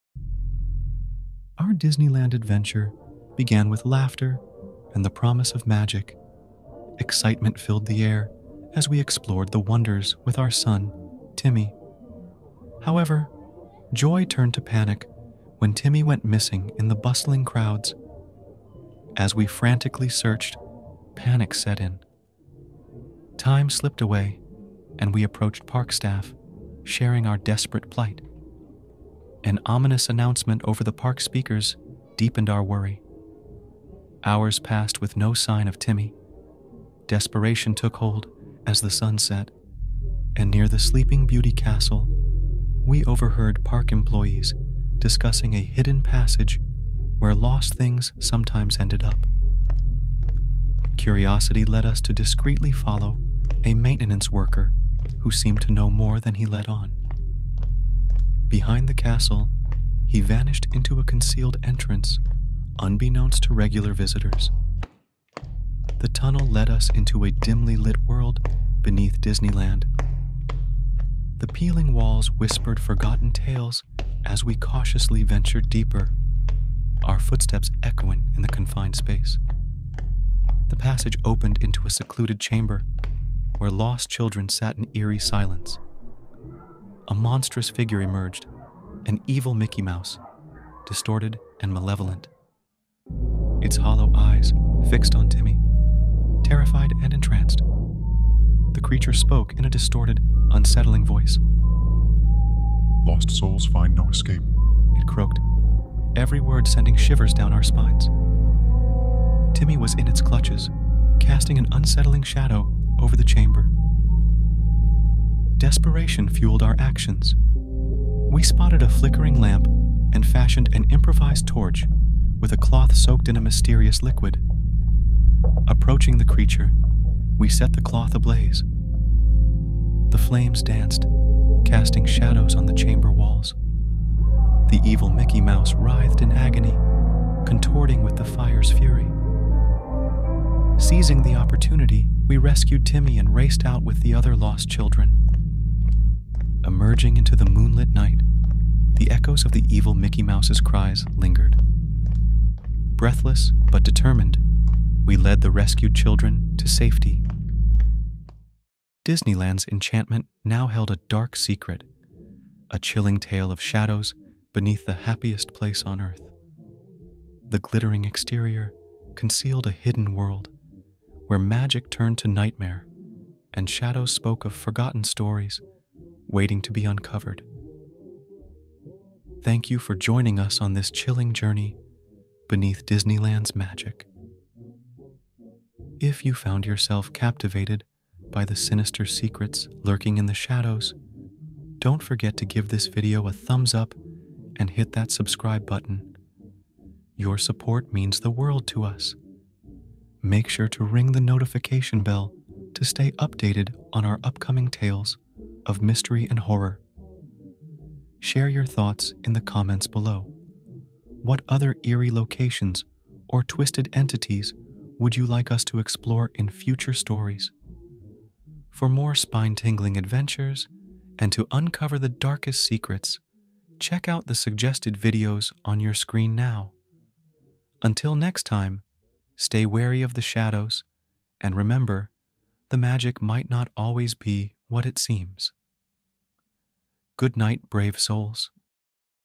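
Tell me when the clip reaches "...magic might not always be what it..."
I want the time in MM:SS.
03:52.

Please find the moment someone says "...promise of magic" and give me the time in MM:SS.
00:05.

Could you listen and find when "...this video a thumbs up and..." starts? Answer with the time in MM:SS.
03:12.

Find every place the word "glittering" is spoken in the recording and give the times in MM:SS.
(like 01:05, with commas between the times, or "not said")
02:47.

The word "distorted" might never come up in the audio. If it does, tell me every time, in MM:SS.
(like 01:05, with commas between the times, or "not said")
01:30, 01:39.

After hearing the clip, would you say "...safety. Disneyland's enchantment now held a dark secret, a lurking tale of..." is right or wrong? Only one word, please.
wrong.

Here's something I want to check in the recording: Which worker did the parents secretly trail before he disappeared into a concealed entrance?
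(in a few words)
a maintenance worker.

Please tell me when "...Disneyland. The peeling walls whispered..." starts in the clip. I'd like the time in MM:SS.
01:09.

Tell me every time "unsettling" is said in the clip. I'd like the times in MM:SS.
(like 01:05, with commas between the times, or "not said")
01:40, 01:51.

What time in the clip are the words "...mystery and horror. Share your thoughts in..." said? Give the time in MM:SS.
03:25.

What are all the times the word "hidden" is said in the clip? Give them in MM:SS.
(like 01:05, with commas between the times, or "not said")
00:45, 02:49.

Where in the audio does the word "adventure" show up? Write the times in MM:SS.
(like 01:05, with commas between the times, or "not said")
00:02, 03:39.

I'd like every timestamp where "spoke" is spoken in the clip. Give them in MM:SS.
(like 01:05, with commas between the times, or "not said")
01:39, 02:54.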